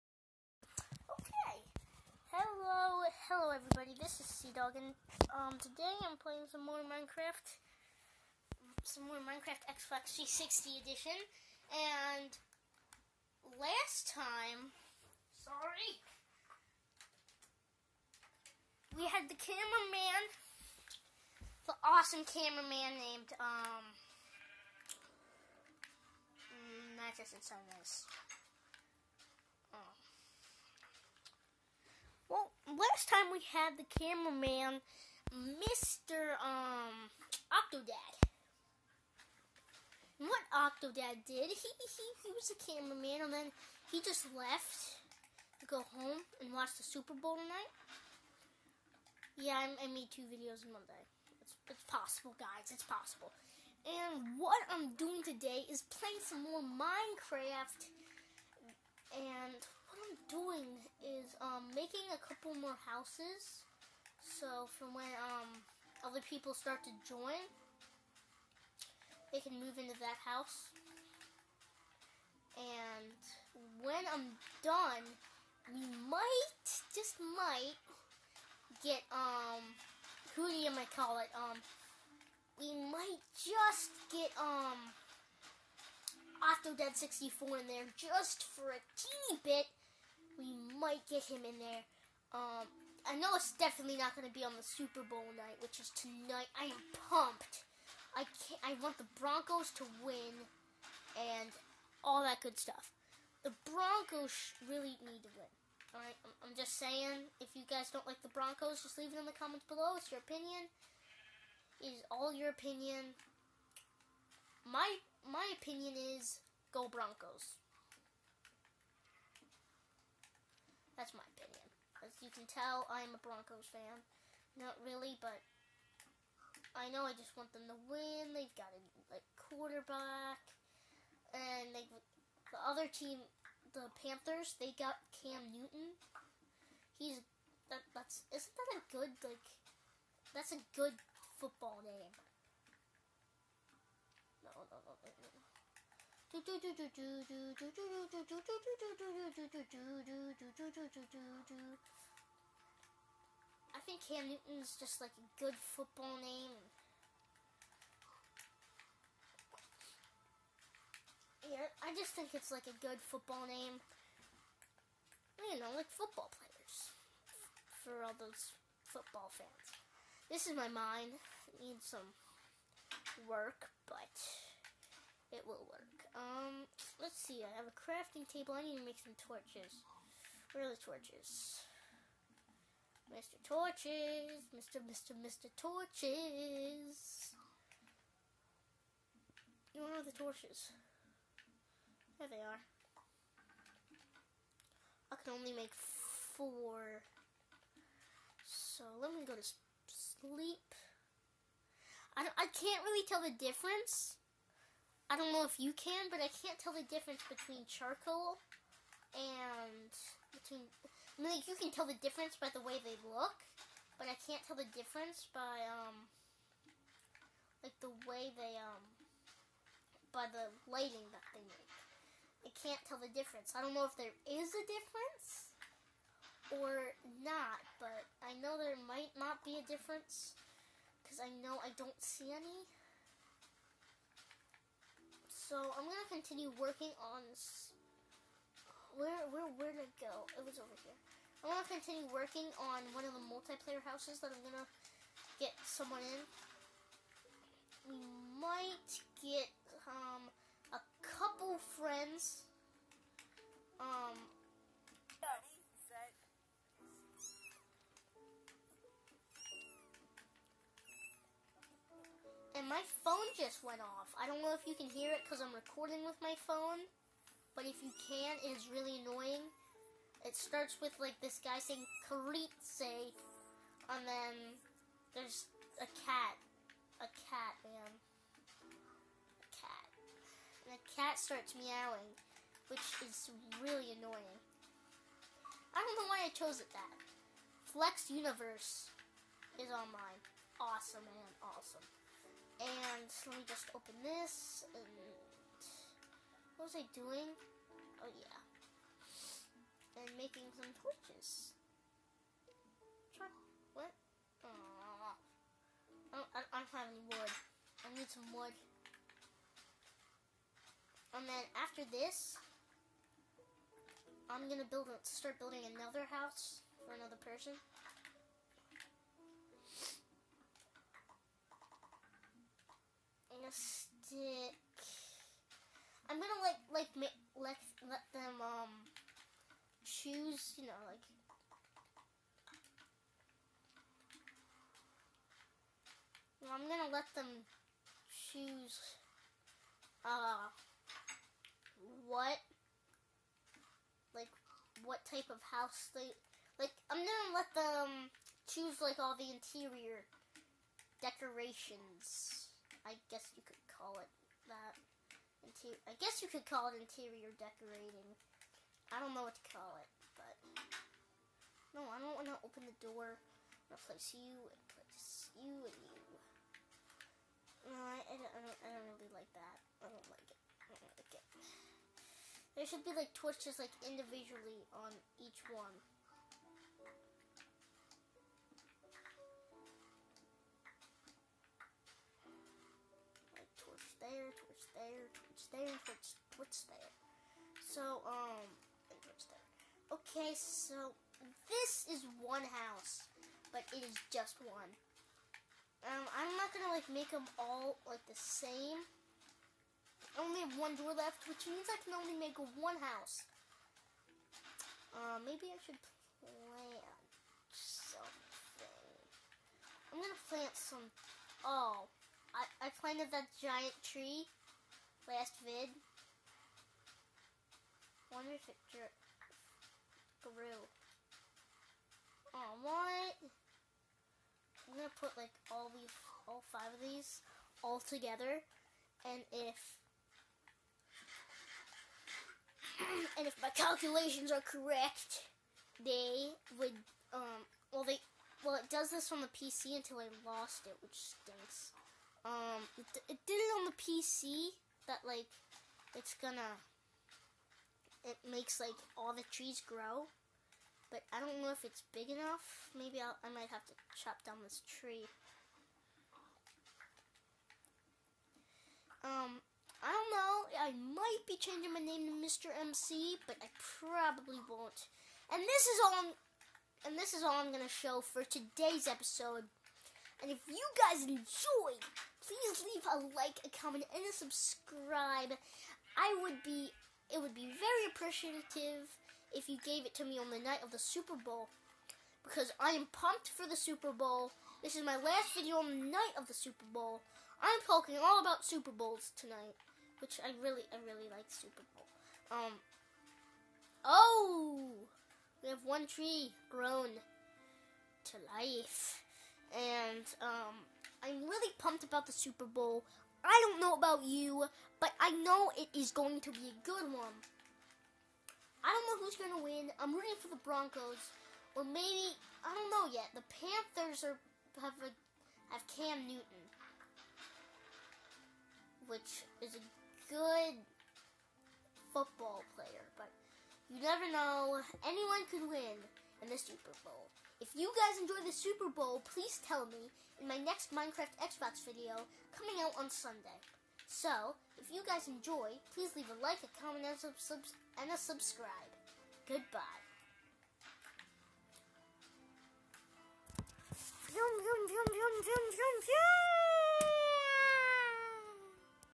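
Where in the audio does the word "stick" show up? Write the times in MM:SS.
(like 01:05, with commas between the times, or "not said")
05:23.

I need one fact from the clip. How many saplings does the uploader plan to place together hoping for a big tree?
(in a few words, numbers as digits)
5.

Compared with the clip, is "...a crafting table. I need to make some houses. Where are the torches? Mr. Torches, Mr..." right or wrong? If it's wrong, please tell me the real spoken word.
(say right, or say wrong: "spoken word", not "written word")
wrong: "torches", not "houses".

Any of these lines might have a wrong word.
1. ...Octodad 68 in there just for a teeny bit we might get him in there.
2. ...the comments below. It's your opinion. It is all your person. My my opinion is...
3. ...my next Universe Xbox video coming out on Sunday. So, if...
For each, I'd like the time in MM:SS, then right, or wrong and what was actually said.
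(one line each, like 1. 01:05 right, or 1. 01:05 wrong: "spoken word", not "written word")
1. 01:26 wrong: "64", not "68"
2. 01:49 wrong: "opinion", not "person"
3. 08:50 wrong: "Minecraft", not "Universe".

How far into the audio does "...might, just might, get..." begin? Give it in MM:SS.
01:16.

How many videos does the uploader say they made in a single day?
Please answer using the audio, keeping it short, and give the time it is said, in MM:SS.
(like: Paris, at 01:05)
2, at 00:50.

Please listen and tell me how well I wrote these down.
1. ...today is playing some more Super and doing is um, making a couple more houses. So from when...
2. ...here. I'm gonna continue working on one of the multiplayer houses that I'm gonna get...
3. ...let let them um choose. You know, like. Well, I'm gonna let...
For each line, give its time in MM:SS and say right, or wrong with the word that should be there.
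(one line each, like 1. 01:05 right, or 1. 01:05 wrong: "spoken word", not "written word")
1. 00:55 wrong: "Minecraft", not "Super"
2. 04:00 right
3. 05:27 right.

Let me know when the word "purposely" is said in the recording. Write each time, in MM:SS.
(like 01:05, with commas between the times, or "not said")
not said.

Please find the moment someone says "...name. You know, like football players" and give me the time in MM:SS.
02:43.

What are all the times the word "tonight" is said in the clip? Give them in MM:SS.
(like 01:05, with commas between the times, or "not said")
00:47, 01:35, 08:09.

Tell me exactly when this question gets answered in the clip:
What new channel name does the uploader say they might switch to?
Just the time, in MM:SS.
07:42.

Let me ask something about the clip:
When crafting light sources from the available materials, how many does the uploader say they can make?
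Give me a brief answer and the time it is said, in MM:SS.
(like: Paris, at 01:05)
4, at 03:15.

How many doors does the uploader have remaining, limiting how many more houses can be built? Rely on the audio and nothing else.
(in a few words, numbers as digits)
1.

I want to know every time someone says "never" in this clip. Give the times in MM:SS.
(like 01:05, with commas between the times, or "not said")
08:43.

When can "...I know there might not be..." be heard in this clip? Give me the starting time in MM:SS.
03:48.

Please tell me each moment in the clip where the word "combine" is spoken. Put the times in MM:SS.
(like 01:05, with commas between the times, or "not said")
not said.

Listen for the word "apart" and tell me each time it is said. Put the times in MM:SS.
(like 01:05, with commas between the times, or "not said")
not said.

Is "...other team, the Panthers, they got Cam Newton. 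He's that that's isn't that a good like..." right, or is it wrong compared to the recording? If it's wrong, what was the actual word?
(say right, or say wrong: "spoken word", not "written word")
right.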